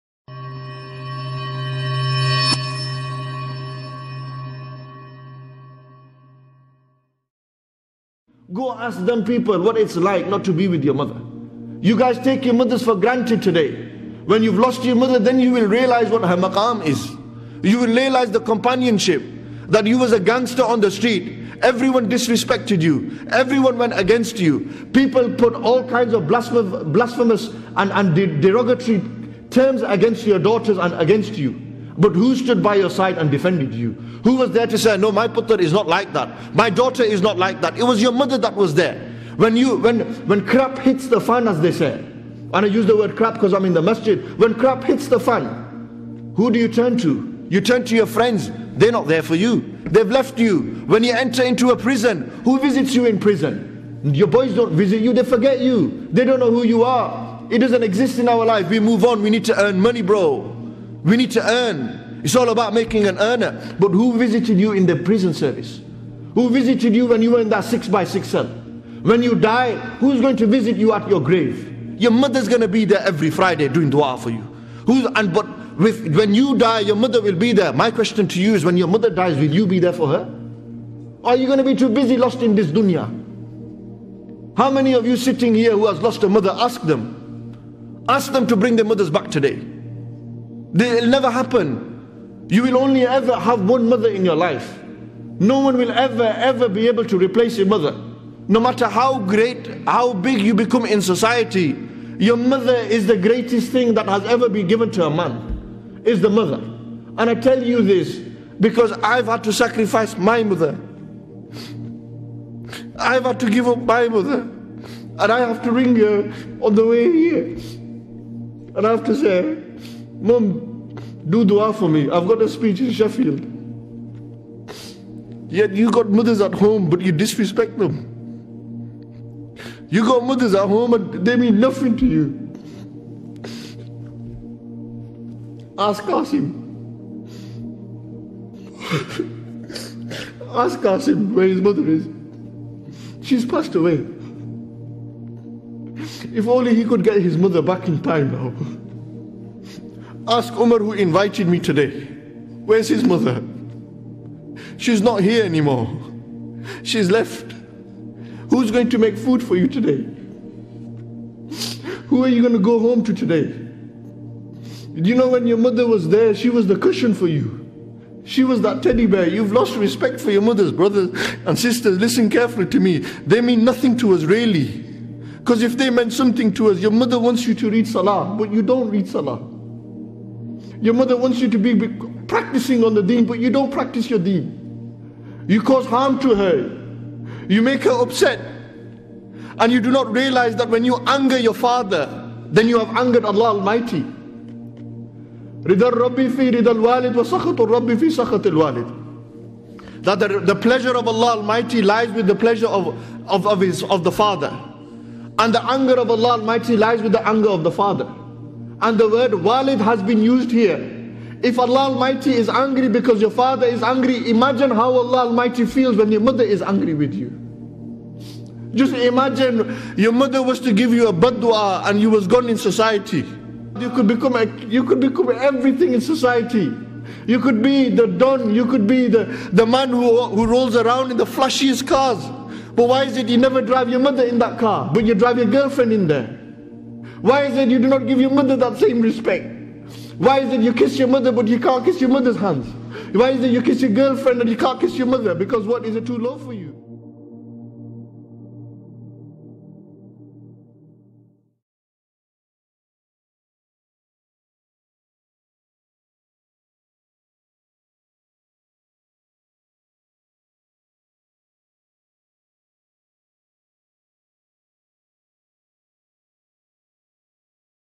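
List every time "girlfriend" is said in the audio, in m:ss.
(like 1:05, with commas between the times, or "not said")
3:55, 4:03.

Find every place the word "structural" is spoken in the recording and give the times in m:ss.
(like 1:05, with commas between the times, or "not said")
not said.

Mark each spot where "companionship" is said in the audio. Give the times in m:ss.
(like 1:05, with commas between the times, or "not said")
0:18.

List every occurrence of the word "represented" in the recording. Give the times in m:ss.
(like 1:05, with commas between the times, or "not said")
not said.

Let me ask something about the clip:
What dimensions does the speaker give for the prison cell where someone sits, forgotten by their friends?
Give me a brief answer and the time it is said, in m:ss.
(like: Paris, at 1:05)
six by six, at 1:07.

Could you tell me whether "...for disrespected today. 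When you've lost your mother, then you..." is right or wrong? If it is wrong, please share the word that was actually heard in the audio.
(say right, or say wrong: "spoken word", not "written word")
wrong: "granted", not "disrespected".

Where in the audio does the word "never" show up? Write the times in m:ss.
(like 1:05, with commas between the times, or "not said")
1:31, 3:53.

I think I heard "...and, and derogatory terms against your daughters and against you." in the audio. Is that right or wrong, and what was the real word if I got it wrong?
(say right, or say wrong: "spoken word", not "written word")
right.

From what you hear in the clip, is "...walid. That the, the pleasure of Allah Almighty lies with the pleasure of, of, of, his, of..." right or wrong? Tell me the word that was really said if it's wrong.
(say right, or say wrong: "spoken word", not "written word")
right.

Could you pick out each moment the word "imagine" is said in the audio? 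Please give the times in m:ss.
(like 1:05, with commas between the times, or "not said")
3:34, 3:38.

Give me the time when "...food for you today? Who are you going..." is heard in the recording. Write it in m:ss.
2:39.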